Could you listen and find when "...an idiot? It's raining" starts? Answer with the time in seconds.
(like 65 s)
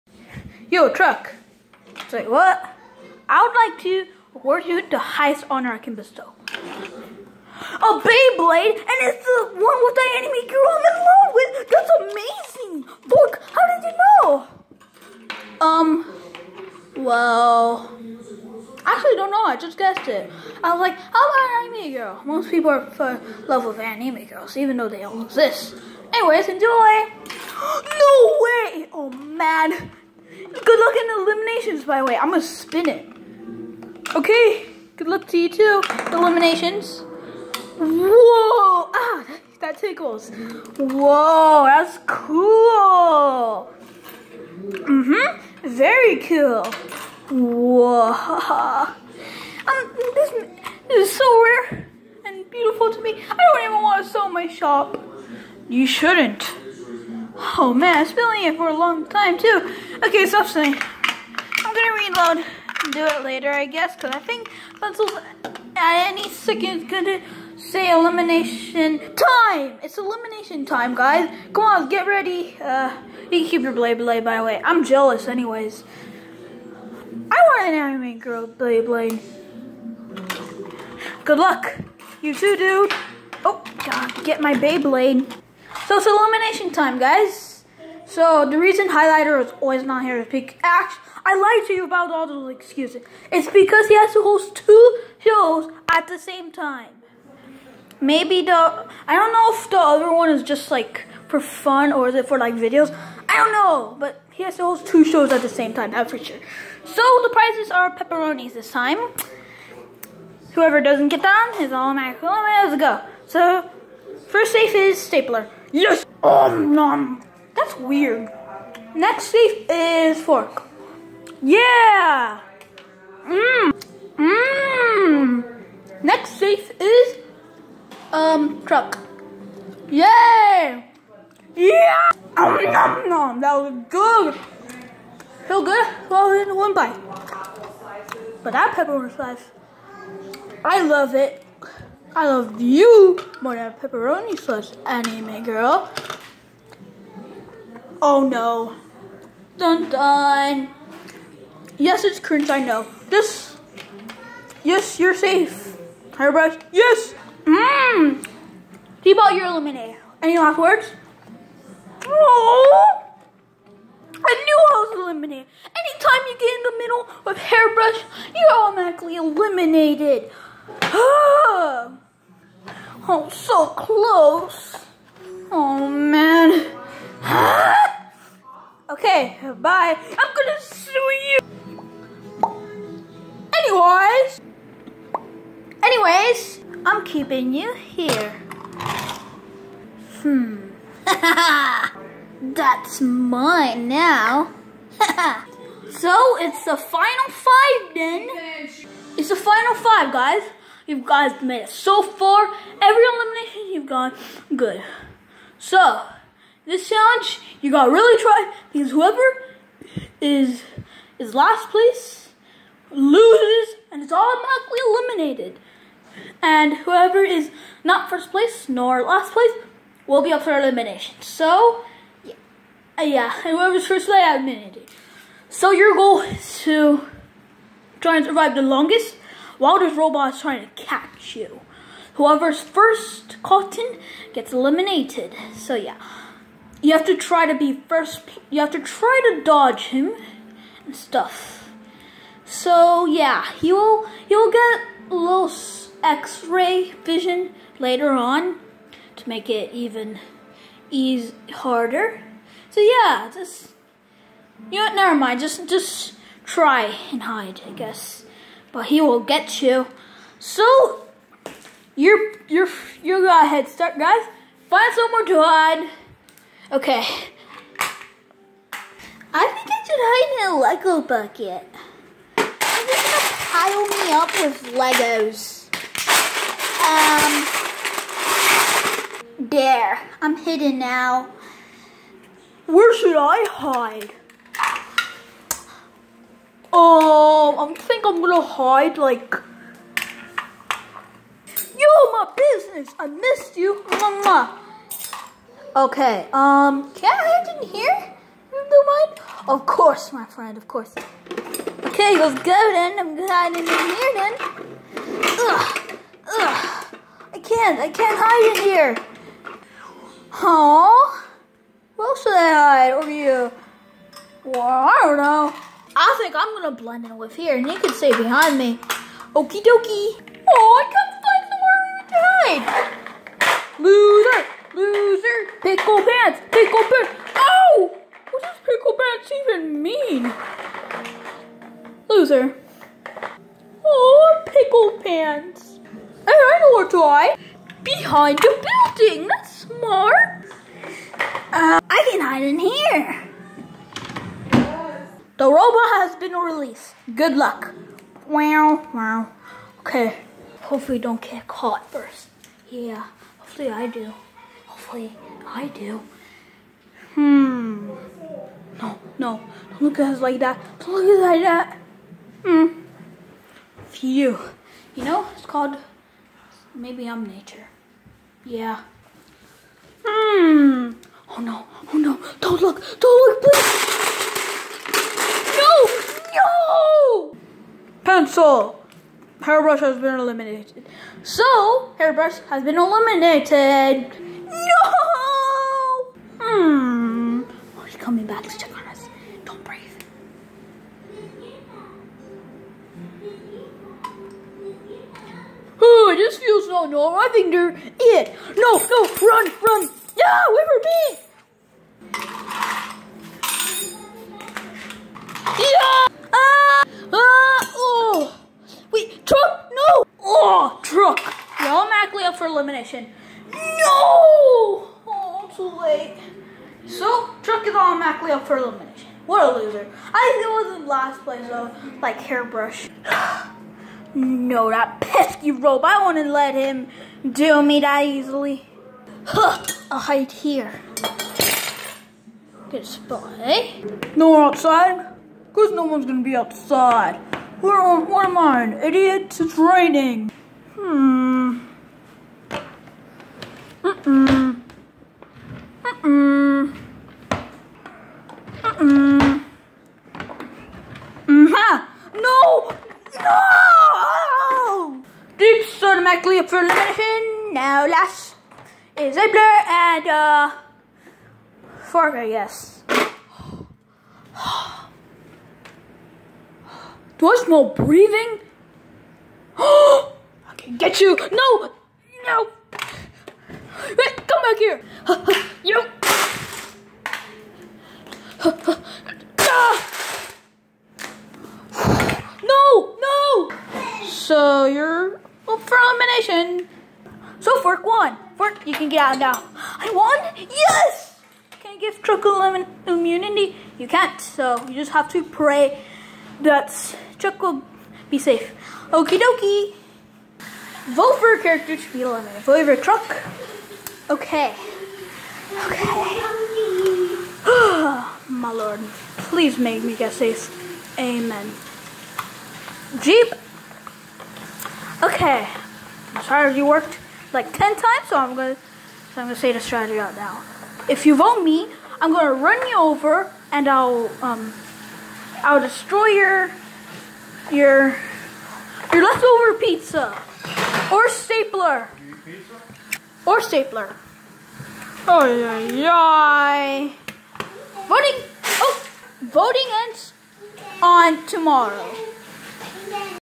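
438 s.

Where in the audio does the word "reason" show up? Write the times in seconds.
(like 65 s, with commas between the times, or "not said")
88 s.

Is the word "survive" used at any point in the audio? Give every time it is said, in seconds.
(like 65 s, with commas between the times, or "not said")
228 s.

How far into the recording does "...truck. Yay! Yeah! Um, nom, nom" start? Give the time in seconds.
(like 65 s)
128 s.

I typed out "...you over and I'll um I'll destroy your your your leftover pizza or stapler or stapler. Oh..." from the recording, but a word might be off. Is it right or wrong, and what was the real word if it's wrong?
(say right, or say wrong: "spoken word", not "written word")
right.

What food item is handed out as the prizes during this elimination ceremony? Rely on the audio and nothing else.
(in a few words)
Pepperonis.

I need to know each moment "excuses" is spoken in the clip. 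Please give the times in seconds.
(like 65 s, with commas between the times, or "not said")
92 s.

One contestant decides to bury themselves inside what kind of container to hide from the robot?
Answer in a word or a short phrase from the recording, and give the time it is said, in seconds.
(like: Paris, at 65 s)
Lego bucket, at 270 s.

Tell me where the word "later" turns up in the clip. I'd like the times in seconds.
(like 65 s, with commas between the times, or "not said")
63 s, 247 s.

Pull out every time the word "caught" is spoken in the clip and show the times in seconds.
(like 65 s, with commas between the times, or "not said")
233 s, 351 s.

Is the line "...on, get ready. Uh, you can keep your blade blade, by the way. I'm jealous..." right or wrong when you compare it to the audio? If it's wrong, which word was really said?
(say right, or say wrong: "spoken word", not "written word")
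right.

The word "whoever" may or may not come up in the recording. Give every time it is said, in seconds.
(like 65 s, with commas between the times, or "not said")
110 s, 208 s, 216 s, 223 s, 232 s.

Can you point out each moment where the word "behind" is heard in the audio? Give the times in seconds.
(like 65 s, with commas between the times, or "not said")
318 s, 337 s.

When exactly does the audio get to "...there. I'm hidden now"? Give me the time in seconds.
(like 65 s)
279 s.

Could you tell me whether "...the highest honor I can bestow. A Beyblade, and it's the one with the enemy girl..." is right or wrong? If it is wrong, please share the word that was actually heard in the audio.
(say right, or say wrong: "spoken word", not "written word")
right.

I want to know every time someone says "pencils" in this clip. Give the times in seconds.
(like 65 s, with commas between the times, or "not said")
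64 s, 378 s.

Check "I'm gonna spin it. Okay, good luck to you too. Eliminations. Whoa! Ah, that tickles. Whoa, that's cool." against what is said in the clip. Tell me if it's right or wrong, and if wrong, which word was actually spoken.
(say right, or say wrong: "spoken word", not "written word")
right.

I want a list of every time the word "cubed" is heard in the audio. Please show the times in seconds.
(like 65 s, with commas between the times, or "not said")
not said.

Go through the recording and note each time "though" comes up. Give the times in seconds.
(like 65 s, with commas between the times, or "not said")
24 s, 421 s.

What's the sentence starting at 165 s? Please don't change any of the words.
Anytime you get in the middle of hairbrush, you're automatically eliminated.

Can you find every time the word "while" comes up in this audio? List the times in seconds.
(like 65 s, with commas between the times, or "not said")
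229 s.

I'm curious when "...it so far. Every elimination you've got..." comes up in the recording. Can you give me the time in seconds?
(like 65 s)
201 s.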